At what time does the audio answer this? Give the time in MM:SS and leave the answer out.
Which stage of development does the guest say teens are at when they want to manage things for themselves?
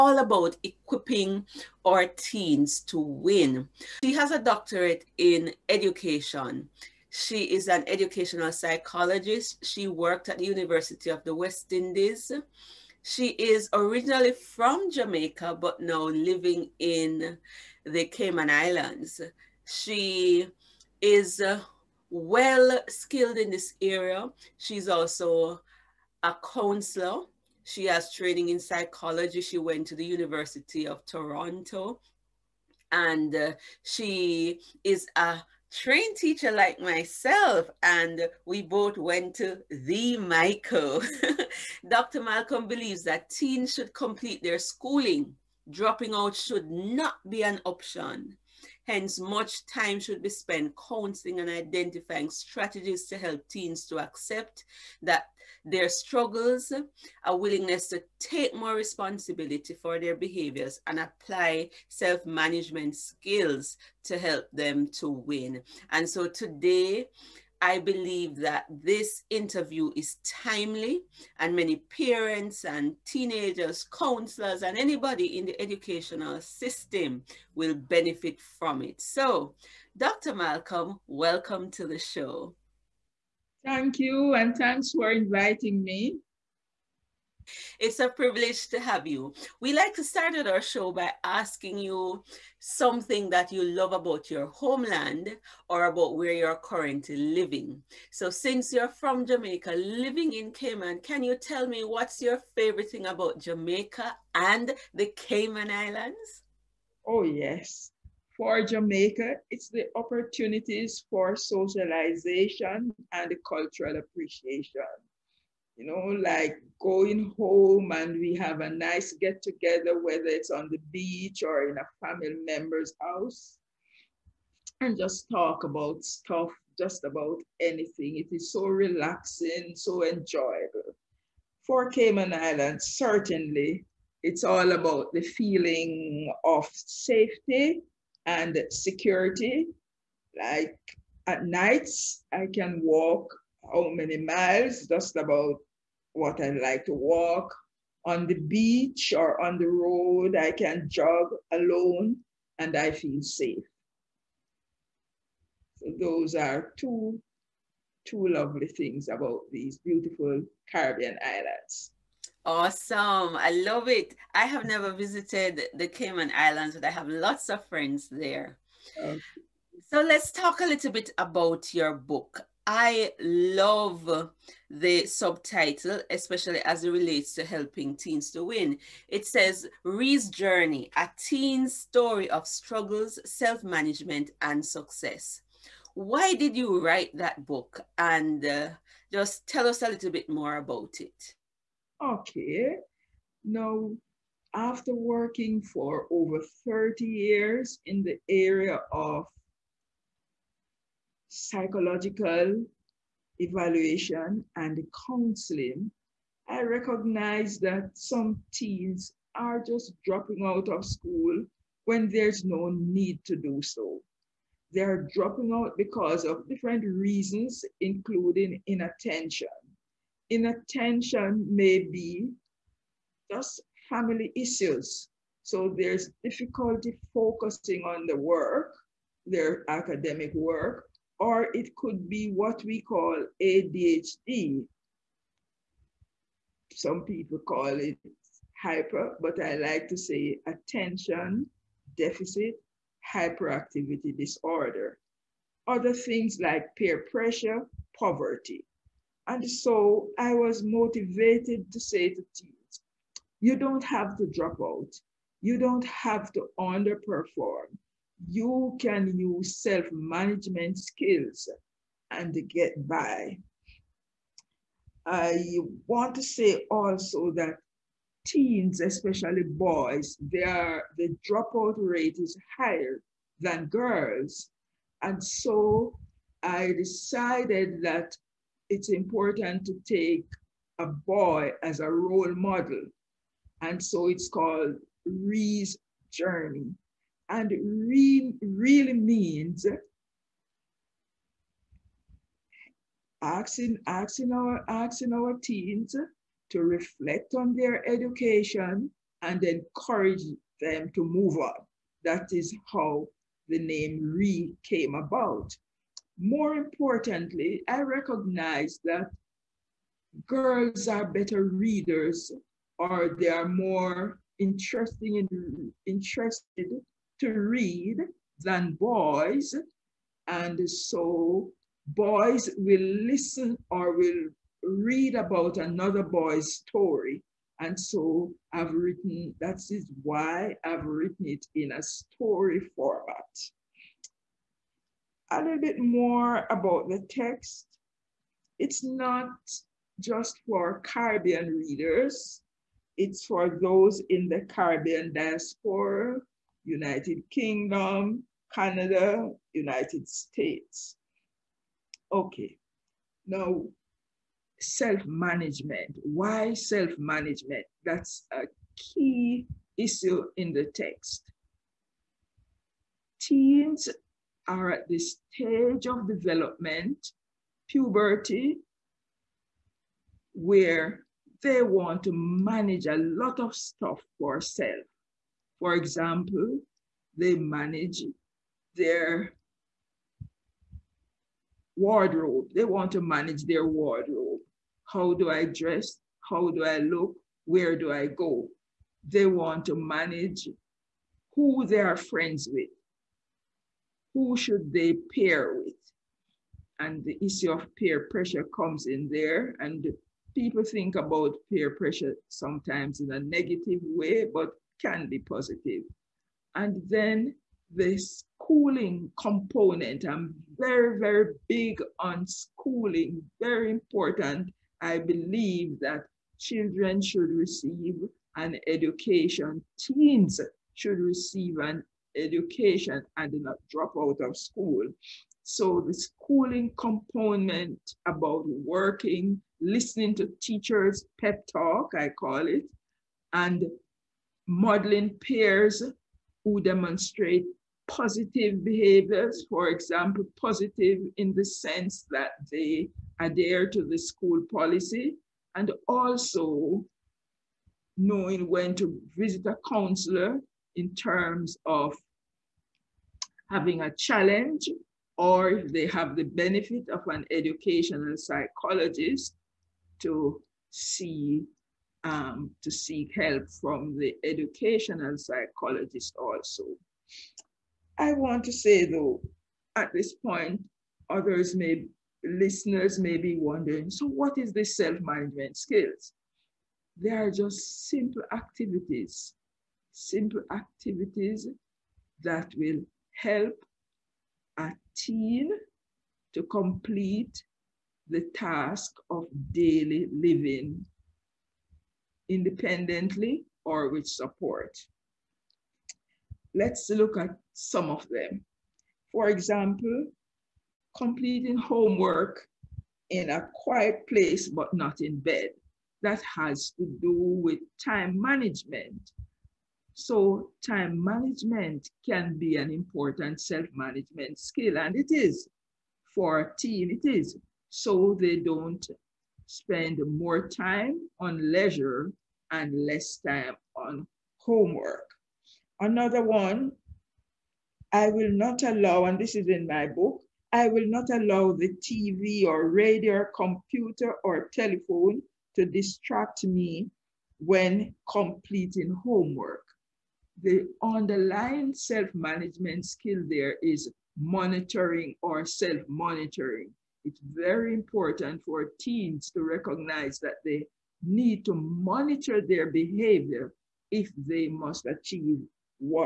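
06:07.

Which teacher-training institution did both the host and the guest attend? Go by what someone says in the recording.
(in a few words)
the Mico.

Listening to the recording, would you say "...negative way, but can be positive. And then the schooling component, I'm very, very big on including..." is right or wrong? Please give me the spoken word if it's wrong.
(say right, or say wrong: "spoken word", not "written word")
wrong: "schooling", not "including".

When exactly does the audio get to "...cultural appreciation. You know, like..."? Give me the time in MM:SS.
01:53.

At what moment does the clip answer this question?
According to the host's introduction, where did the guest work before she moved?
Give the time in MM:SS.
00:10.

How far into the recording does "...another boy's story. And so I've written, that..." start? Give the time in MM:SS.
05:25.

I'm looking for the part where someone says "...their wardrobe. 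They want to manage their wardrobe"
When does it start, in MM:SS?
06:18.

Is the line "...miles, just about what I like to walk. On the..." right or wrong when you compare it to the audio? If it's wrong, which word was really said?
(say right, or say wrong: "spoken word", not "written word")
right.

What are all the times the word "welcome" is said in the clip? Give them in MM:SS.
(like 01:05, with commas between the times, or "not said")
01:21.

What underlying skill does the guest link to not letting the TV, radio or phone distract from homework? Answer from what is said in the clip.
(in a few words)
Self-monitoring.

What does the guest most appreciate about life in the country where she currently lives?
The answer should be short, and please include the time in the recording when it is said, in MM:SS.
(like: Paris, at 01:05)
Safety and security, at 02:16.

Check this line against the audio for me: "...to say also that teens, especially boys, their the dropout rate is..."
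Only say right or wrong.
right.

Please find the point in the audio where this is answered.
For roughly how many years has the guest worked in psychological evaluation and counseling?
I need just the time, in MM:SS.
03:16.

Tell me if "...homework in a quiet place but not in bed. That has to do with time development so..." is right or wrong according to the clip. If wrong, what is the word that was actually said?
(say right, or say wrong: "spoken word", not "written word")
wrong: "management", not "development".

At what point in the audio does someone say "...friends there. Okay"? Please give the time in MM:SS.
02:47.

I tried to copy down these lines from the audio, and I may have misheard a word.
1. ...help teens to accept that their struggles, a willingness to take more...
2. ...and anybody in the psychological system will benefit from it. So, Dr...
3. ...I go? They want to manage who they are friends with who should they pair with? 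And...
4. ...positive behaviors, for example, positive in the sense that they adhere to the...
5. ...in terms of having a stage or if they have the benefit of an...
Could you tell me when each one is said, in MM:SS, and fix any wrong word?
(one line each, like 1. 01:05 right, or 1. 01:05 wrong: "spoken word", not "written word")
1. 00:53 right
2. 01:14 wrong: "educational", not "psychological"
3. 06:27 right
4. 07:17 right
5. 07:30 wrong: "challenge", not "stage".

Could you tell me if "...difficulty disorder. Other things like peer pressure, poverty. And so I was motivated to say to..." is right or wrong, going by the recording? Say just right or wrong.
wrong.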